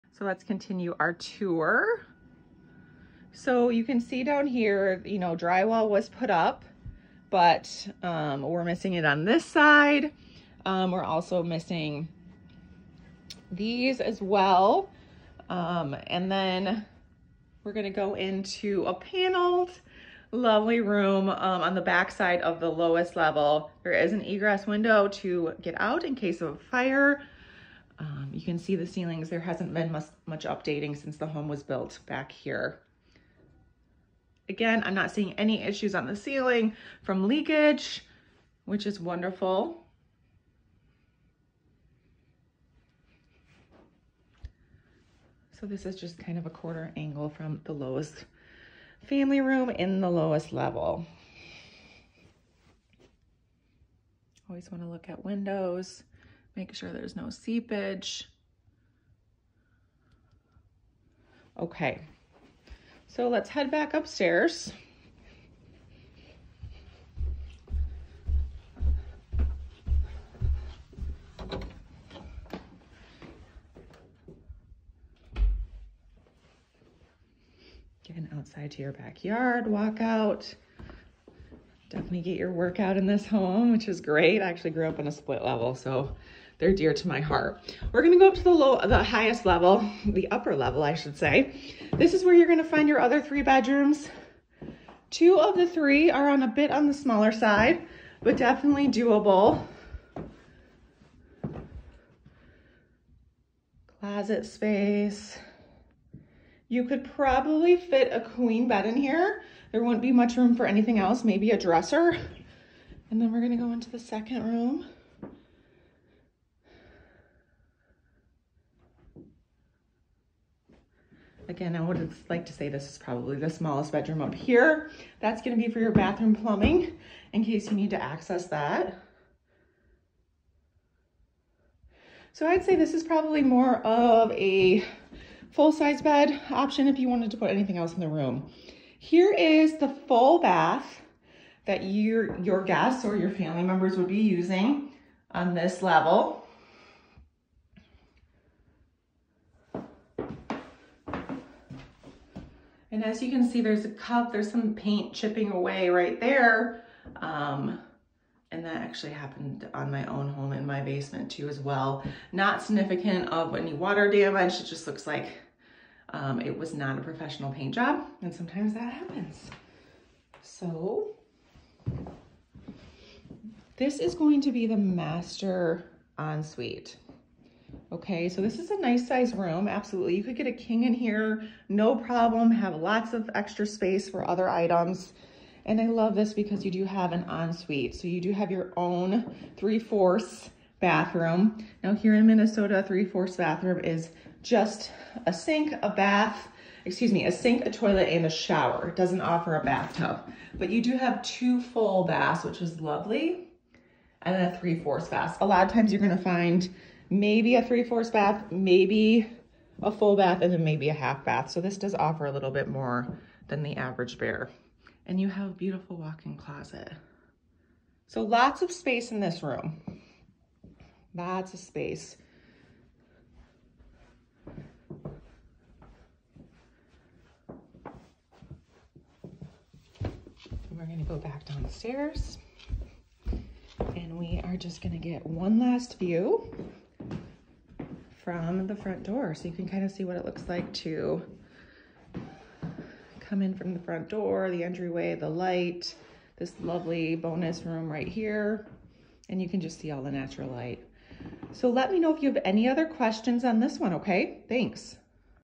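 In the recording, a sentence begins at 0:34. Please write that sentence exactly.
Again, I'm not seeing any issues on the ceiling from leakage, which is wonderful.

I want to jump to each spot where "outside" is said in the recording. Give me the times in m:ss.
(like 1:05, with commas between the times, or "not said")
1:18.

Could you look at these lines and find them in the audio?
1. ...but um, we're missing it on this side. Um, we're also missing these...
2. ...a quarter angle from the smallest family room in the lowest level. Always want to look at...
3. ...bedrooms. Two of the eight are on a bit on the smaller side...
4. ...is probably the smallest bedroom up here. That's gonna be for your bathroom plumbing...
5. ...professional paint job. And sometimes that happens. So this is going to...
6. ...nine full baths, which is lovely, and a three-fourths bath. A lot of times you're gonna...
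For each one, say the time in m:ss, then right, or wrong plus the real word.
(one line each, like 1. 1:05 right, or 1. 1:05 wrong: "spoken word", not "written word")
1. 0:07 right
2. 0:46 wrong: "lowest", not "smallest"
3. 1:33 wrong: "three", not "eight"
4. 2:02 right
5. 2:47 right
6. 3:21 wrong: "two", not "nine".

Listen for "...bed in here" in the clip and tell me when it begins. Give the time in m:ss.
1:48.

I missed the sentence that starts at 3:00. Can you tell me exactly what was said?
You could get a king in here, no problem, have lots of extra space for other items.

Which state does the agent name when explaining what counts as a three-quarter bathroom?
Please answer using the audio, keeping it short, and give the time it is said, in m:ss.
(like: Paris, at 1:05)
Minnesota, at 3:12.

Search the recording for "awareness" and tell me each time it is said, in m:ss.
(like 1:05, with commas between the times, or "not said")
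not said.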